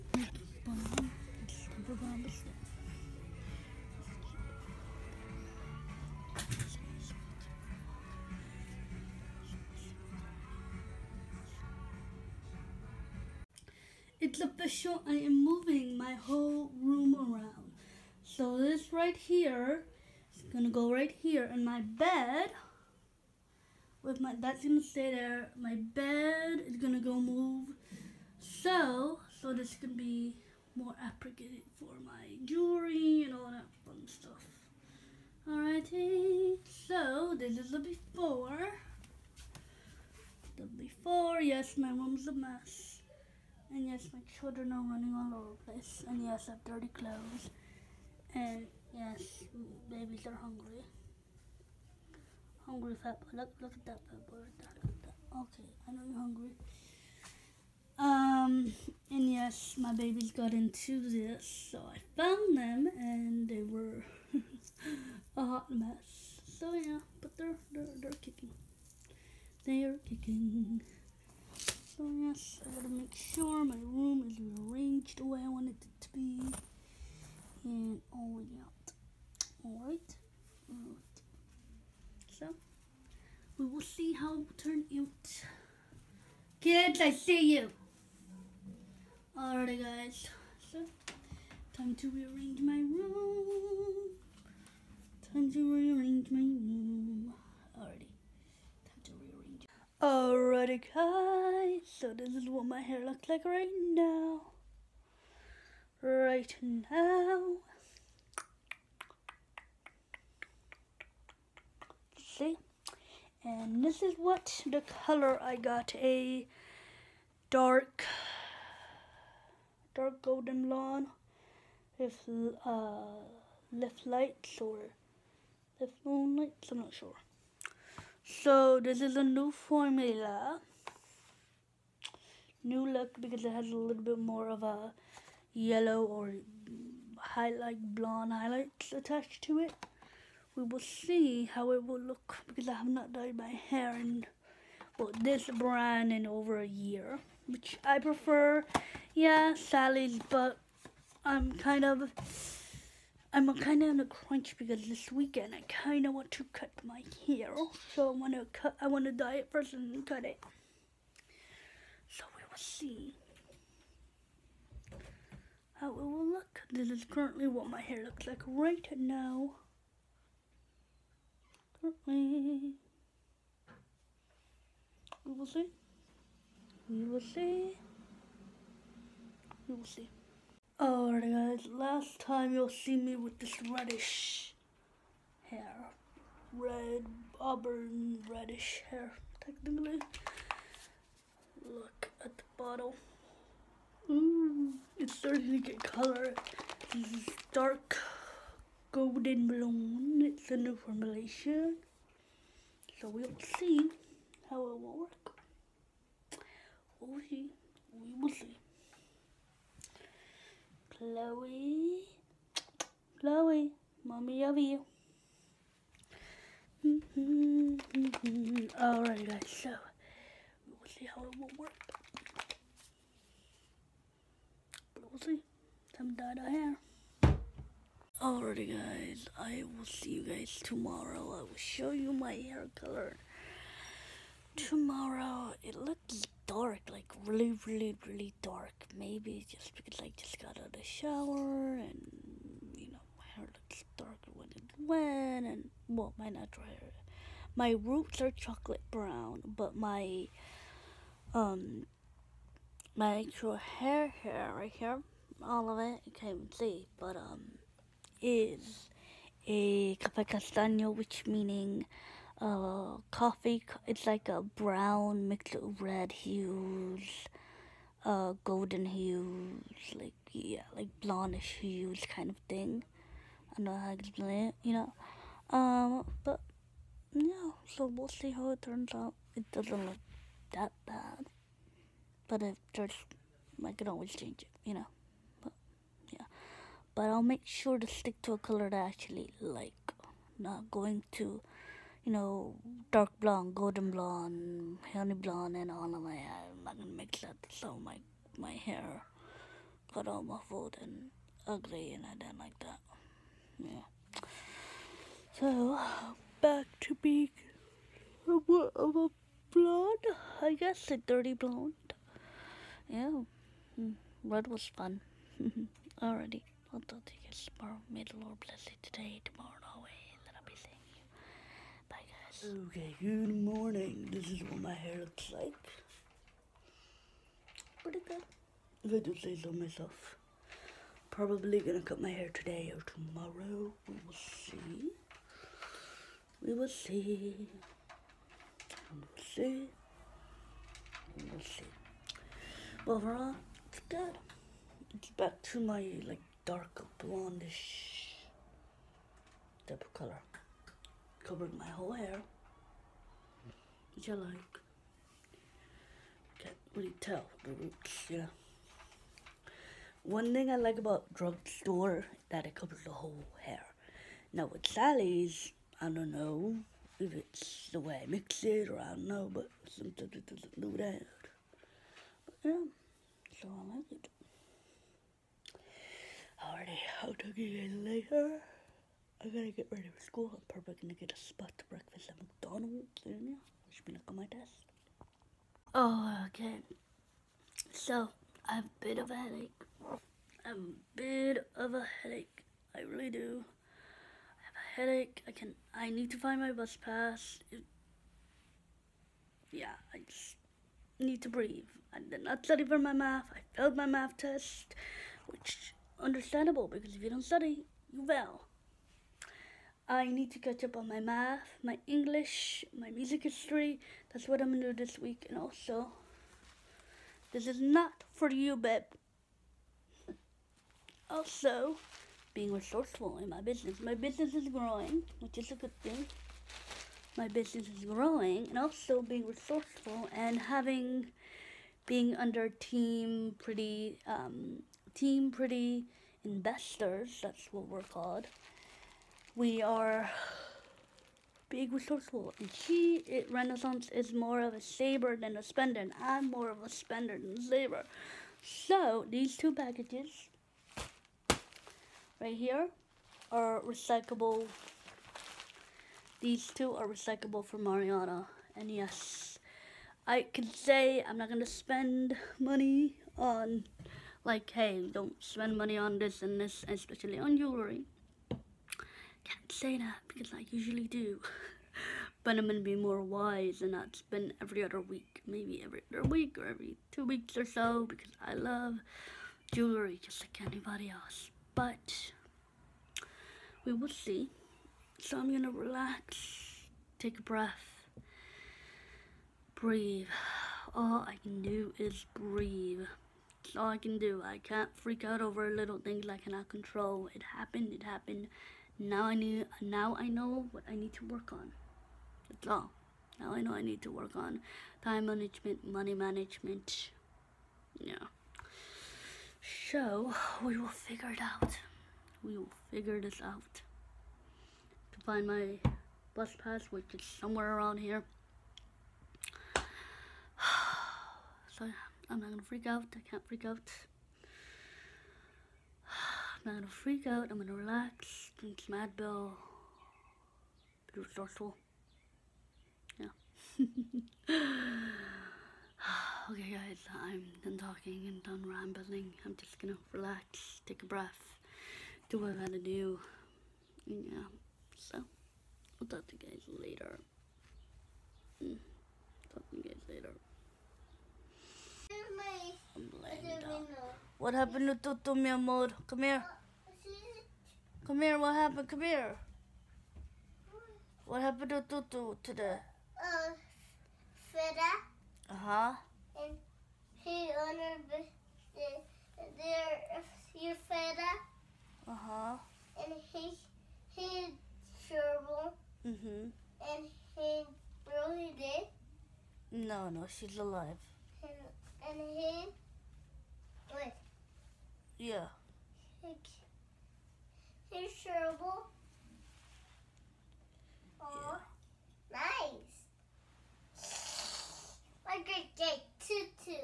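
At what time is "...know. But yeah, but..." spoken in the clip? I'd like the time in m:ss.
4:44.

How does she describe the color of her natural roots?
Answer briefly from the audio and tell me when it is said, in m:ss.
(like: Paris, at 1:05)
Chocolate brown, at 4:08.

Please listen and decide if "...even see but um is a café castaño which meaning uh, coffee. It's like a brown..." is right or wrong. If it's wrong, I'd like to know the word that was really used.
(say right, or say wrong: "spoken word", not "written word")
right.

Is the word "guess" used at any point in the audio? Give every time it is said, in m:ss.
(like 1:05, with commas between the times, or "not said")
5:10.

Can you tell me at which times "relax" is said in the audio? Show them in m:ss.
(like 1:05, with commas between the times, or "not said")
8:05, 8:47, 8:59.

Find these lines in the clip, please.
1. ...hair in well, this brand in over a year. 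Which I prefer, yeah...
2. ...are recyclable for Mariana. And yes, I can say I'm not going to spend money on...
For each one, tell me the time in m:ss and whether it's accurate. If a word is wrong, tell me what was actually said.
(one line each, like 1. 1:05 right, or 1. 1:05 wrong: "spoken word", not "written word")
1. 2:23 right
2. 7:36 right.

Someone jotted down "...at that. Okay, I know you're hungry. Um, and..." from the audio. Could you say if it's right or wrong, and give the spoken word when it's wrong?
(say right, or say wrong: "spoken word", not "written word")
right.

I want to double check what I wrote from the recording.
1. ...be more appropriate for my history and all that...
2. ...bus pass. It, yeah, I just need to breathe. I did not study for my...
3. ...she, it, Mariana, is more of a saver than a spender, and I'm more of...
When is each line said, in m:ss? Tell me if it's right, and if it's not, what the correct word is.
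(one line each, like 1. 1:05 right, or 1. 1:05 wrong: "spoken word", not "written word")
1. 0:29 wrong: "jewelry", not "history"
2. 6:36 right
3. 7:22 wrong: "Renaissance", not "Mariana".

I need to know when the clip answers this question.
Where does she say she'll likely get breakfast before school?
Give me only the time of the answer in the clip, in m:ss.
6:22.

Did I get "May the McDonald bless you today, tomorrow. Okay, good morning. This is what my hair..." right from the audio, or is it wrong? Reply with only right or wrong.
wrong.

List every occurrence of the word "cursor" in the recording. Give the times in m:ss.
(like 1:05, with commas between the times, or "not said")
not said.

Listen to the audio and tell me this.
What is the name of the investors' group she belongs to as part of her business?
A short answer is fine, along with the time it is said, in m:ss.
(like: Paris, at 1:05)
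Team Pretty Investors, at 7:14.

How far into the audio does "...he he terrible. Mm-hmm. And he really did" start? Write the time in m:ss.
9:33.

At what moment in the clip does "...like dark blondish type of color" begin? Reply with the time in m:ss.
5:46.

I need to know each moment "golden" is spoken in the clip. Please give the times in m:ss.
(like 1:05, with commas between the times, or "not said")
2:00, 3:18, 4:28, 4:53.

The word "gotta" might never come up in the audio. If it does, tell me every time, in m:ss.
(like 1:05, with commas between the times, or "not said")
1:12, 6:19, 9:02.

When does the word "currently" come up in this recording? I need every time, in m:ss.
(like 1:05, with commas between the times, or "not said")
2:47, 2:51.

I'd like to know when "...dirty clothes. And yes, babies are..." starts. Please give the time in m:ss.
0:46.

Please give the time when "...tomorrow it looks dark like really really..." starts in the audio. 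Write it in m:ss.
3:54.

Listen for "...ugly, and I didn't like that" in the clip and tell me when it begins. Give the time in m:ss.
5:01.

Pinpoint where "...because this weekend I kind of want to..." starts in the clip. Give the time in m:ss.
2:34.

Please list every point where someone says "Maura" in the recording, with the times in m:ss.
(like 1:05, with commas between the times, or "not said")
not said.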